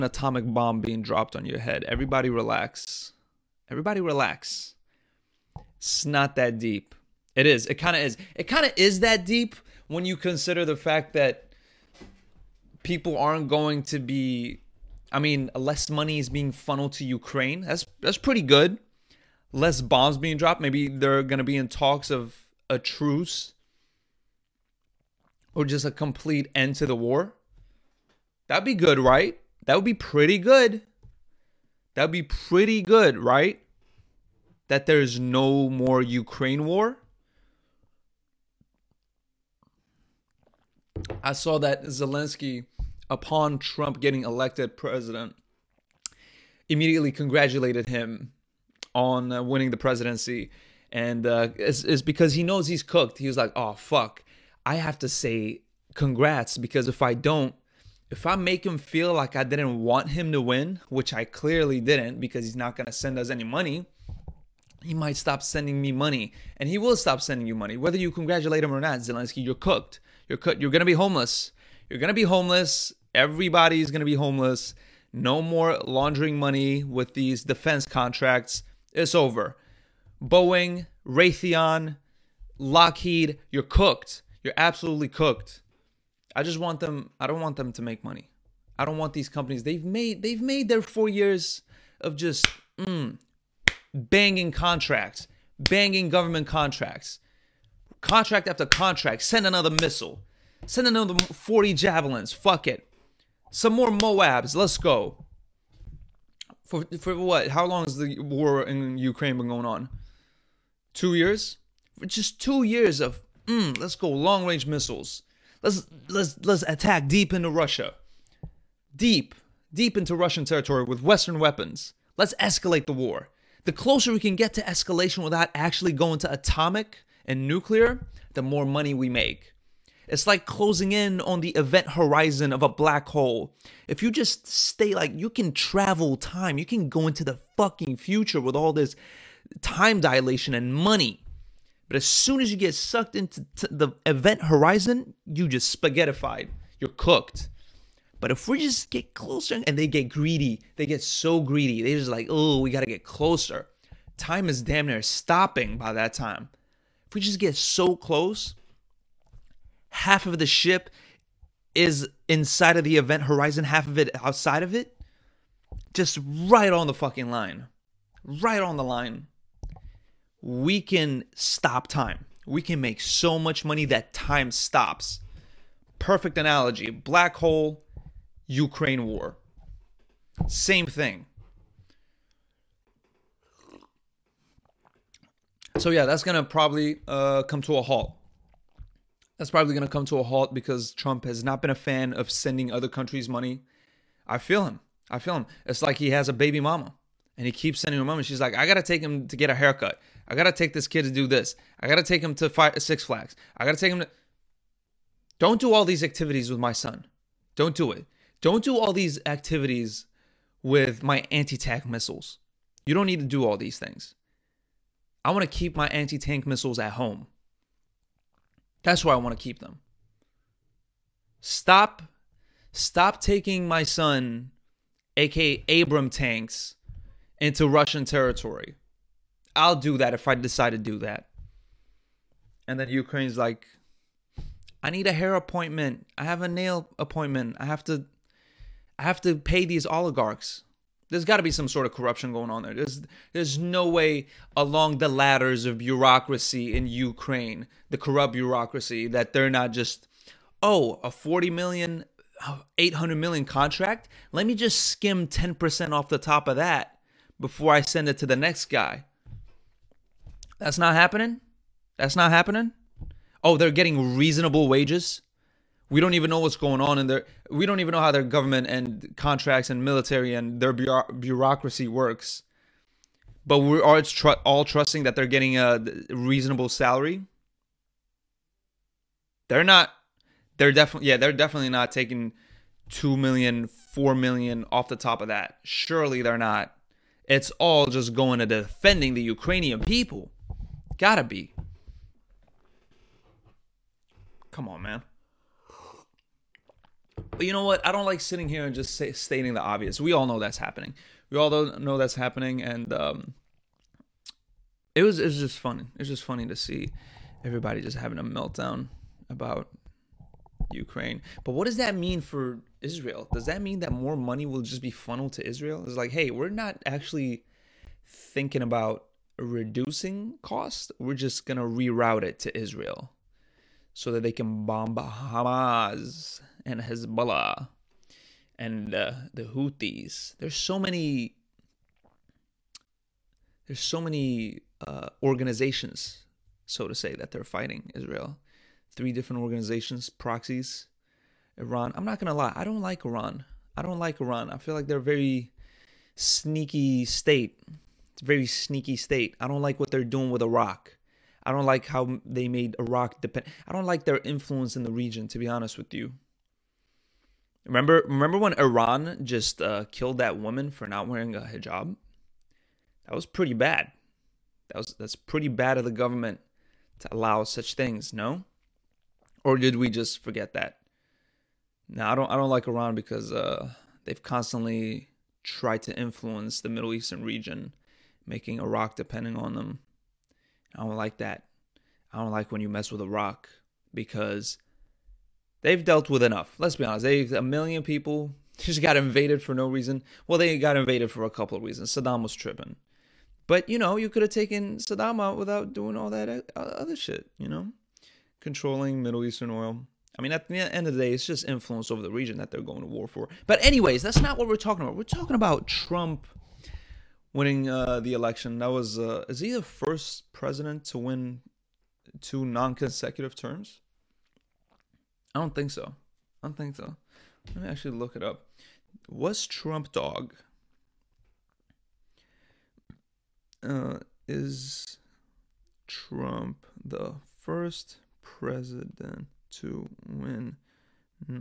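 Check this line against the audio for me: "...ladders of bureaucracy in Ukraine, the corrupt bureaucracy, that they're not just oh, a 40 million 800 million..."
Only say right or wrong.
right.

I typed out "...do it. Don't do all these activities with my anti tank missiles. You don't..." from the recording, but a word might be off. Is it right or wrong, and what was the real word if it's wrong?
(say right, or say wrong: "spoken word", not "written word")
right.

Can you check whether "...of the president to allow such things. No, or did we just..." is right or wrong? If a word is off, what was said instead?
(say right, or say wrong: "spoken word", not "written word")
wrong: "government", not "president".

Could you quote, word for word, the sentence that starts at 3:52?
And then Ukraine's like, I need a hair appointment.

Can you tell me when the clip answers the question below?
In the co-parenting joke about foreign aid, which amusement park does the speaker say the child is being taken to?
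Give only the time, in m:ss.
3:22.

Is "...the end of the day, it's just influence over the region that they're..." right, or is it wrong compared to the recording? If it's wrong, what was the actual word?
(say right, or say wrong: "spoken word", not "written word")
right.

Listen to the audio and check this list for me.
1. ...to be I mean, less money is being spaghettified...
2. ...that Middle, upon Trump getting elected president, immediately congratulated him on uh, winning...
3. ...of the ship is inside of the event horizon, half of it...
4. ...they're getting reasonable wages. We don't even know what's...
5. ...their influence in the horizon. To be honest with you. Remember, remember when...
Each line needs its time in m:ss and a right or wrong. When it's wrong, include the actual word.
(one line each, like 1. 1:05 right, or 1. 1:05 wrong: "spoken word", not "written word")
1. 0:13 wrong: "funneled", not "spaghettified"
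2. 0:41 wrong: "Zelensky", not "Middle"
3. 2:40 right
4. 4:23 right
5. 5:54 wrong: "region", not "horizon".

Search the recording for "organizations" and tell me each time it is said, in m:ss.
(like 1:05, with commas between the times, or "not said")
5:35, 5:39.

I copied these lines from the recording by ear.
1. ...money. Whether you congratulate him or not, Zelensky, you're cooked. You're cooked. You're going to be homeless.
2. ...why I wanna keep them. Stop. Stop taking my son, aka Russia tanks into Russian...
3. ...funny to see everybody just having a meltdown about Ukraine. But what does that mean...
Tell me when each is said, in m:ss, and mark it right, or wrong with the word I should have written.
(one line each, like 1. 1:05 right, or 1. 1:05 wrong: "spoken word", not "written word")
1. 1:07 right
2. 3:39 wrong: "Abram", not "Russia"
3. 5:06 right.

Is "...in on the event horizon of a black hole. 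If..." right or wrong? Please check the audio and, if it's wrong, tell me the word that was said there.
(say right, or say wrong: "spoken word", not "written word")
right.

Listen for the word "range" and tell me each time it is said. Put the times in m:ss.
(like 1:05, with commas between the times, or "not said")
1:54.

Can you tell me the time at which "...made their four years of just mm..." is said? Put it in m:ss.
1:30.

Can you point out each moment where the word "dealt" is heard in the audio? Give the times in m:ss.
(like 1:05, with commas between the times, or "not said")
6:25.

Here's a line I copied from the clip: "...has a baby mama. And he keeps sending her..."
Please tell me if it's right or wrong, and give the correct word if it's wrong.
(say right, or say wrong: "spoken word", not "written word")
right.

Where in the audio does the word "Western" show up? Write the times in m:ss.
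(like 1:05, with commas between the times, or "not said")
2:01.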